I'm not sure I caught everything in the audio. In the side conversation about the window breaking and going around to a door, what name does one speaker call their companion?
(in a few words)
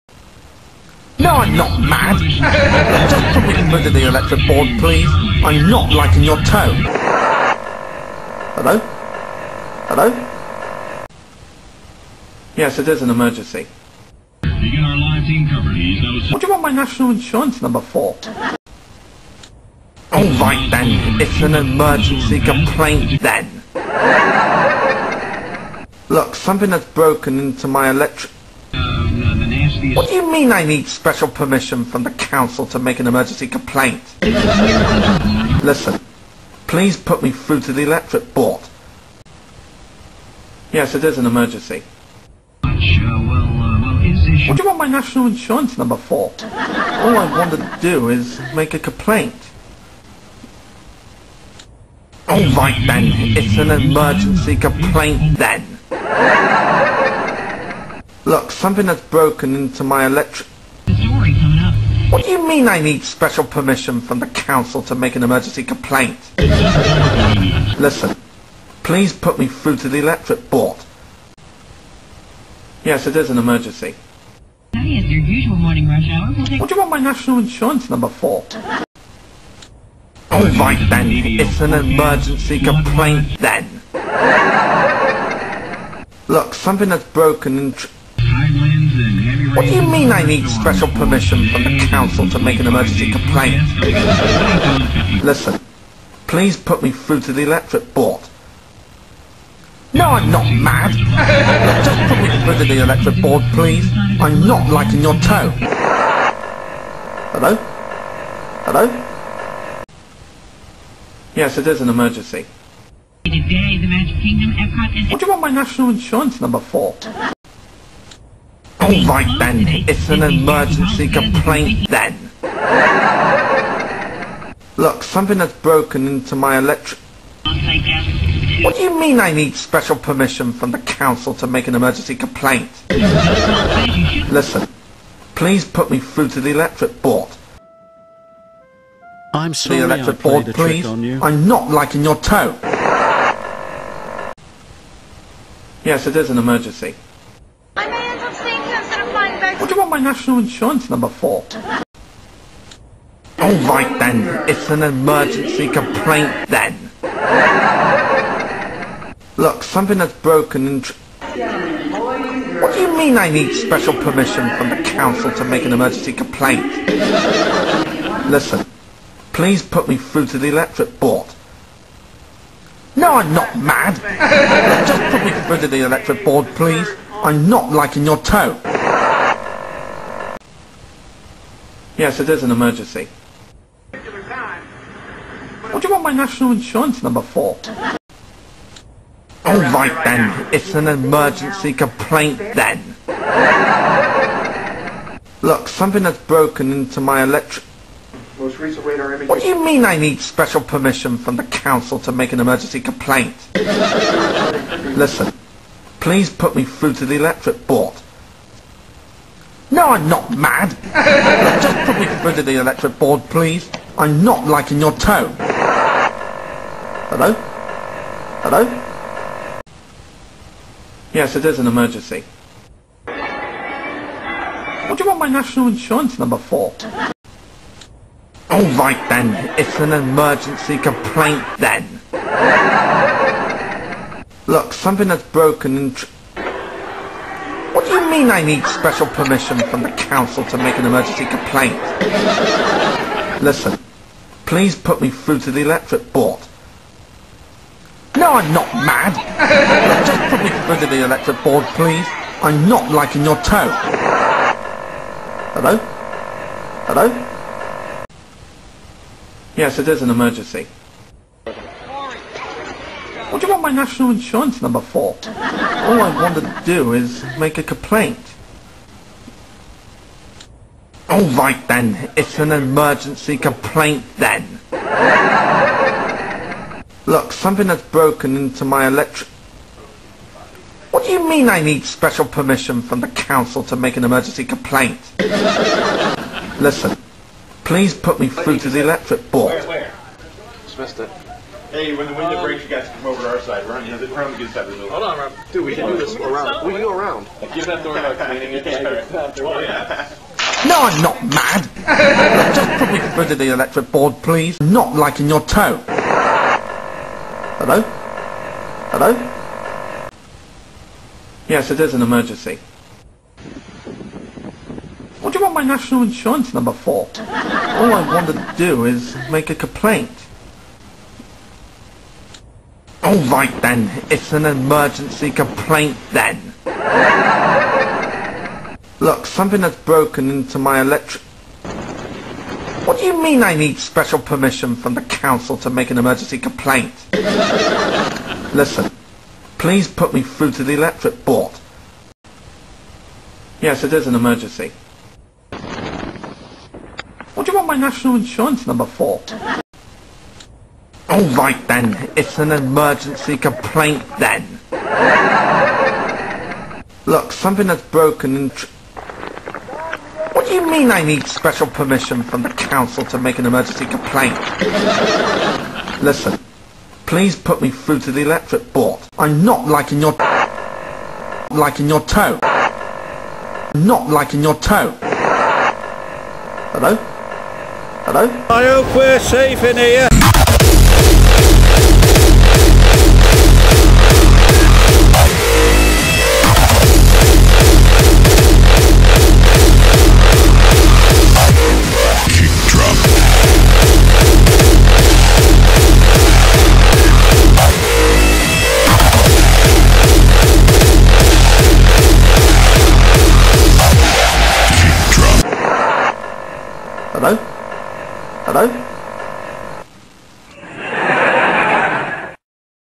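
Rob.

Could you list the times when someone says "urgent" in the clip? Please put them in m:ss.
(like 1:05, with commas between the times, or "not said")
not said.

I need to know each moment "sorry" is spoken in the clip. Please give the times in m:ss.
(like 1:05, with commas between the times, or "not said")
2:19.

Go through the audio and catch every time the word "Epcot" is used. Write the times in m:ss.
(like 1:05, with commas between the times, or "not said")
1:54.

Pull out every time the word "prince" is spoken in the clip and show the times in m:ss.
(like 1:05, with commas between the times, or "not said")
not said.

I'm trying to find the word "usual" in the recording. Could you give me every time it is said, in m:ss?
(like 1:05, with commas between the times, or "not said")
1:15.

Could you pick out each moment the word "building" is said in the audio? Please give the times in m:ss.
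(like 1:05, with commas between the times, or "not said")
4:54.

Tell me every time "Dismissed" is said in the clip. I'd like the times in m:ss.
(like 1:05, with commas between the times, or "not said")
4:50.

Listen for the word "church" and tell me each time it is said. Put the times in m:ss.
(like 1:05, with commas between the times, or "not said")
not said.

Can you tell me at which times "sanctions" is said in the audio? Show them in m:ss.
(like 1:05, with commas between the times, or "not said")
not said.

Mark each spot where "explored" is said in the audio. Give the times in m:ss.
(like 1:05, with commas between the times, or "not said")
not said.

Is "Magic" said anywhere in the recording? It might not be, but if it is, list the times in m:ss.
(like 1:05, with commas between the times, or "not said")
1:53.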